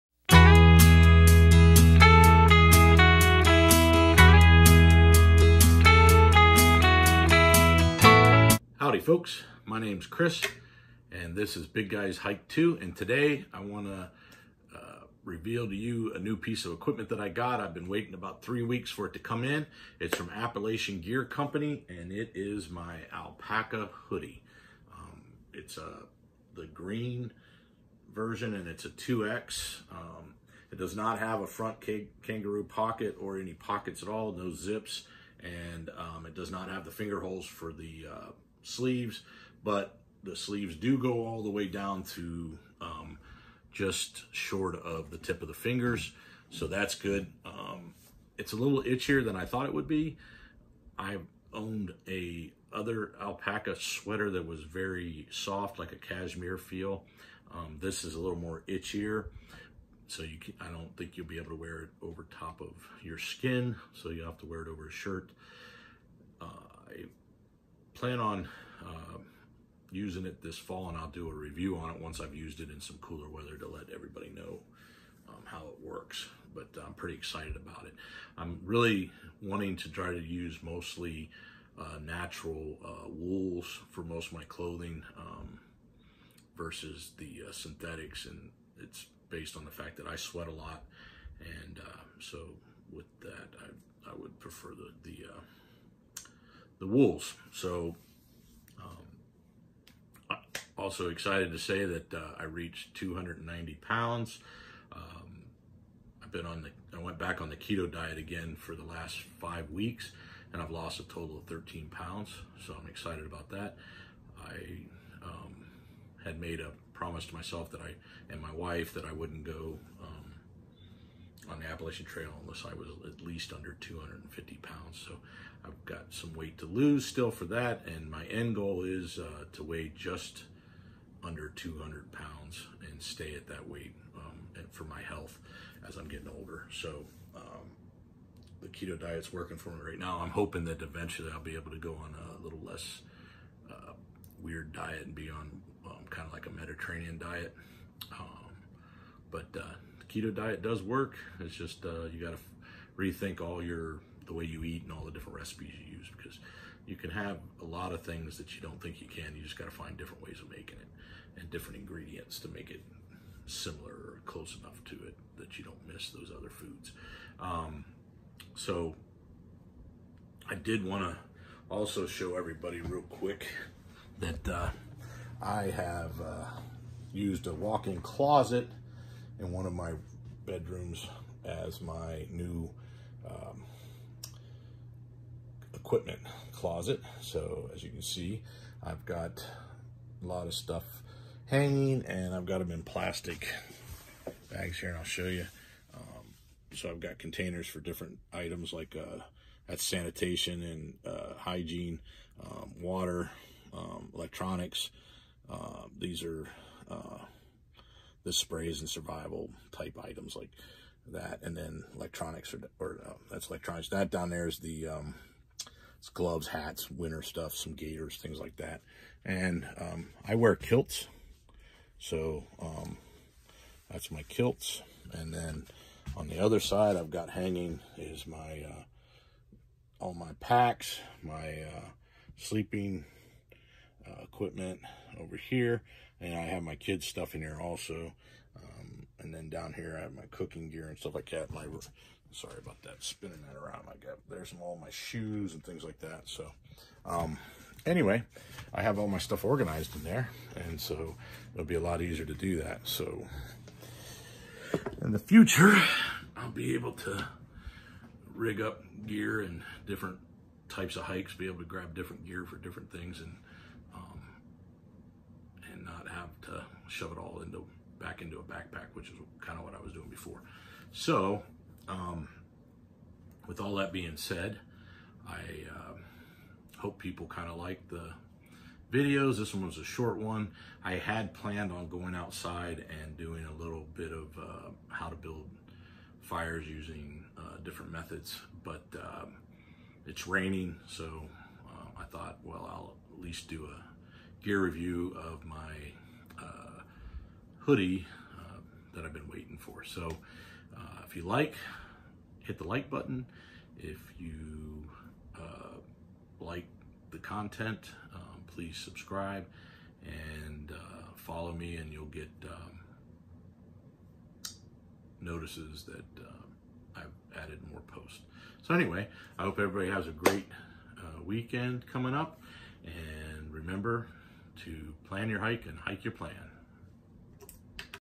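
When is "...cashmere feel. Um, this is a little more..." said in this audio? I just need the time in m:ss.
0:55.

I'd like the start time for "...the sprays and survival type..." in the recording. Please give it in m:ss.
3:28.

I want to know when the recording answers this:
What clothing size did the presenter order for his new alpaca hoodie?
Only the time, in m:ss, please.
0:28.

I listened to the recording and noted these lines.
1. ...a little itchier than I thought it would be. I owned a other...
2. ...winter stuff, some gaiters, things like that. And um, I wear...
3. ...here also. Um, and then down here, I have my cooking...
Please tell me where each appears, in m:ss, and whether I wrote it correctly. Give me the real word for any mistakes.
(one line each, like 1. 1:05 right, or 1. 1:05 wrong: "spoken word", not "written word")
1. 0:48 right
2. 3:36 right
3. 3:57 right.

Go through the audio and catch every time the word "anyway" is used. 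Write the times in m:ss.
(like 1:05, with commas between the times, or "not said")
4:07, 5:18.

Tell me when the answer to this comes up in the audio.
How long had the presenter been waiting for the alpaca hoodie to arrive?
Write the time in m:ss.
0:18.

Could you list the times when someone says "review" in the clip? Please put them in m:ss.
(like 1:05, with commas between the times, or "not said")
1:11, 4:54.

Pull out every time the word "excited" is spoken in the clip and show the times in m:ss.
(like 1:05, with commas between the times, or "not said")
1:17, 1:41, 1:52.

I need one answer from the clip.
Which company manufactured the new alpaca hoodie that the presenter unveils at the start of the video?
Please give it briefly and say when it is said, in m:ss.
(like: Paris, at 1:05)
Appalachian Gear Company, at 0:20.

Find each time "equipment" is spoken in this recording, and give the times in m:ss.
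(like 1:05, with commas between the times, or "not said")
0:16, 3:05, 3:54.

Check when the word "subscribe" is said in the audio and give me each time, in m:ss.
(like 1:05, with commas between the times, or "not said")
5:08.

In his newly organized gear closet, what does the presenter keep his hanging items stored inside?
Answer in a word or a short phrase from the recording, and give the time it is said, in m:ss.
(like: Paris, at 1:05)
plastic bags, at 3:12.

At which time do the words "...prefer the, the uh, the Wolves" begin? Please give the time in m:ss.
1:34.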